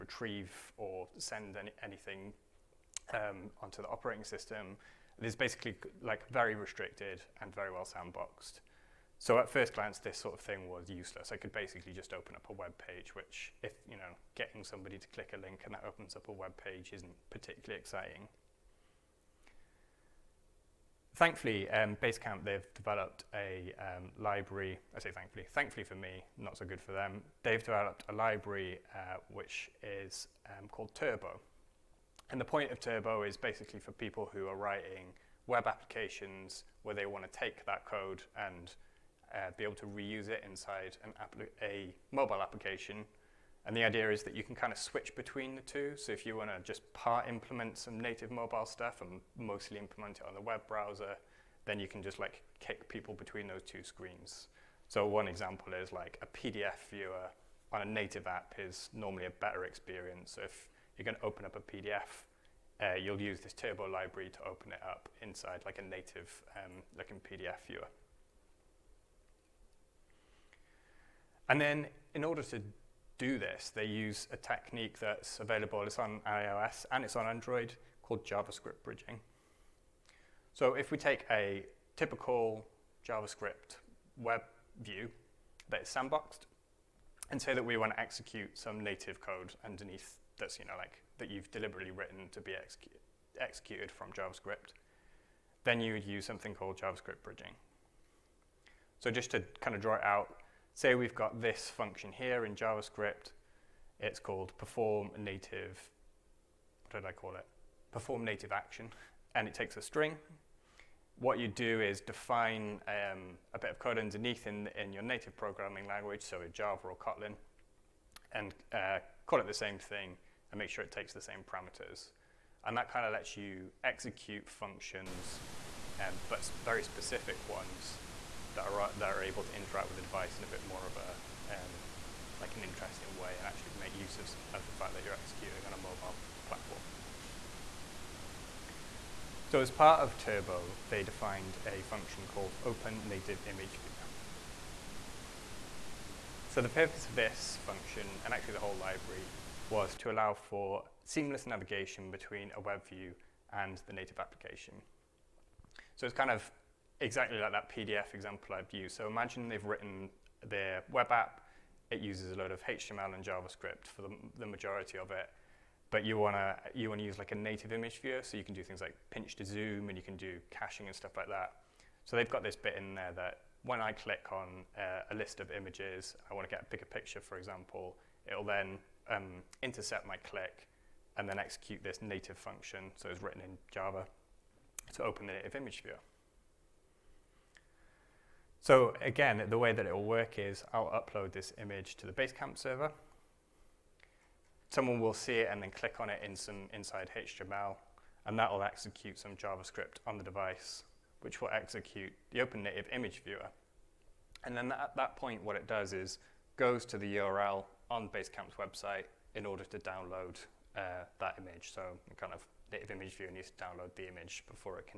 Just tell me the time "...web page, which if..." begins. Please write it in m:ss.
0:12.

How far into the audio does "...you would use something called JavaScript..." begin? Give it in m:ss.
1:35.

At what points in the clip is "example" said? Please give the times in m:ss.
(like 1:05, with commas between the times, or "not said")
0:55, 2:38, 2:57.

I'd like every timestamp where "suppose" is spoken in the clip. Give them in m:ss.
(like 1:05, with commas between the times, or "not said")
not said.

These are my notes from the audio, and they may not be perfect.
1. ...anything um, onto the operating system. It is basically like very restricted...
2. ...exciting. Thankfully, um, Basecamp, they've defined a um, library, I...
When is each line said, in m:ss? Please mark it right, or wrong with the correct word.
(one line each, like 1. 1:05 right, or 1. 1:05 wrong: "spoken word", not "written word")
1. 0:01 right
2. 0:17 wrong: "developed", not "defined".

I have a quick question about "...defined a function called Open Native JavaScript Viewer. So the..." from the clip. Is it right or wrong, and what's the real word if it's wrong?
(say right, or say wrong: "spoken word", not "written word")
wrong: "Image", not "JavaScript".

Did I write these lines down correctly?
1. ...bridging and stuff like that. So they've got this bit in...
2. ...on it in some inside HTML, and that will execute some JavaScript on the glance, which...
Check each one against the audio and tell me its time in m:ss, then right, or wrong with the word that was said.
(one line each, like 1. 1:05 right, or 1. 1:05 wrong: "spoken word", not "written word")
1. 2:50 wrong: "caching", not "bridging"
2. 3:15 wrong: "device", not "glance".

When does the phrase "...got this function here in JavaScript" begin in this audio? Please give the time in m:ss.
1:41.